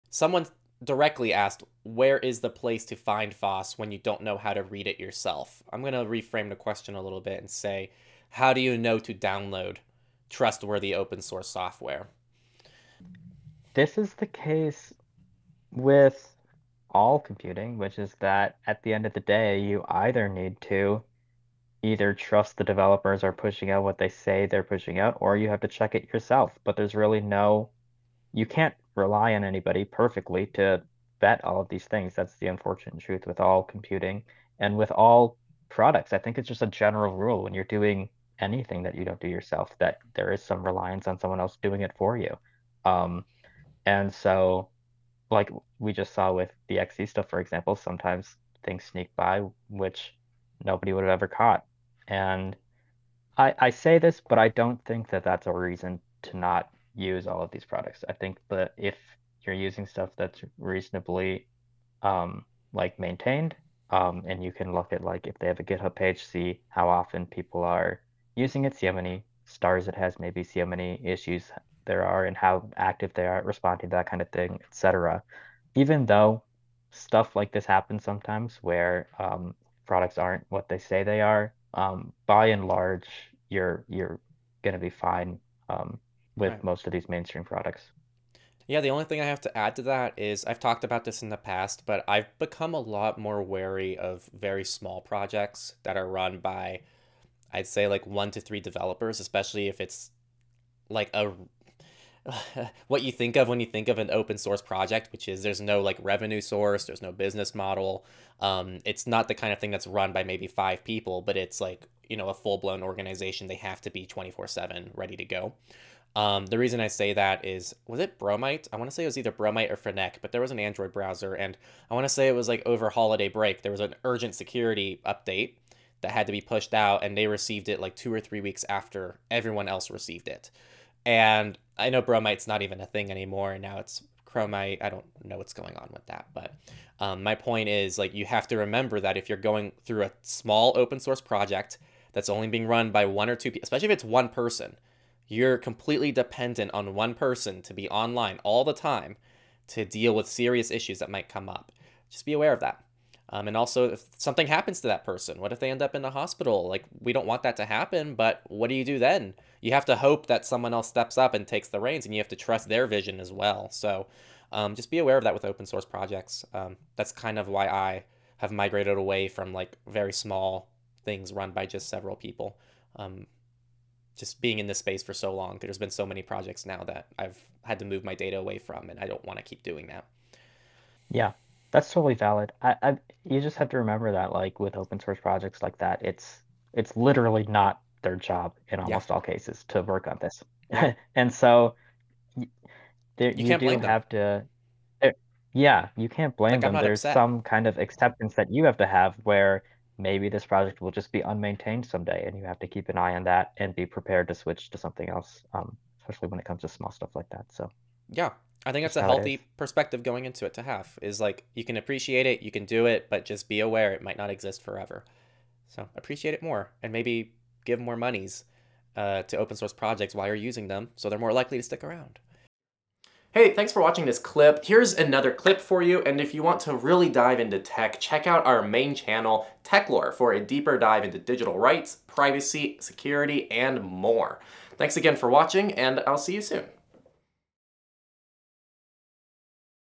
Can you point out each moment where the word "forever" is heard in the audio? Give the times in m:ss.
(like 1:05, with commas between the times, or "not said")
3:34.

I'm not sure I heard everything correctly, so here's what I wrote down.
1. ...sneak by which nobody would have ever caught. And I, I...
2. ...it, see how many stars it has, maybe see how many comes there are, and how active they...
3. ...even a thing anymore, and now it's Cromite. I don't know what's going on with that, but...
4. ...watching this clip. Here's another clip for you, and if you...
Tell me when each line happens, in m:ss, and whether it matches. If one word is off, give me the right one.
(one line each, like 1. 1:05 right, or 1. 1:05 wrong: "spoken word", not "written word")
1. 0:48 right
2. 1:08 wrong: "issues", not "comes"
3. 2:12 right
4. 3:43 right.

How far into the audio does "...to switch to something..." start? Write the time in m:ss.
3:24.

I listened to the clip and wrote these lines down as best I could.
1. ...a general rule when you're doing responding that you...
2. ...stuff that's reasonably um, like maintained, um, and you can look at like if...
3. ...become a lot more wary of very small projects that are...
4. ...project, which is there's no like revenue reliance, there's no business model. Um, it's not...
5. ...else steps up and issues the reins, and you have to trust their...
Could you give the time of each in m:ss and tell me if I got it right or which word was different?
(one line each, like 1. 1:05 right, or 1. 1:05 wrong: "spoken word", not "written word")
1. 0:36 wrong: "anything", not "responding"
2. 0:59 right
3. 1:32 right
4. 1:44 wrong: "source", not "reliance"
5. 2:40 wrong: "takes", not "issues".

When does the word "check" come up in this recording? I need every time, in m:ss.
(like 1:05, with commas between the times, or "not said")
0:25, 3:48.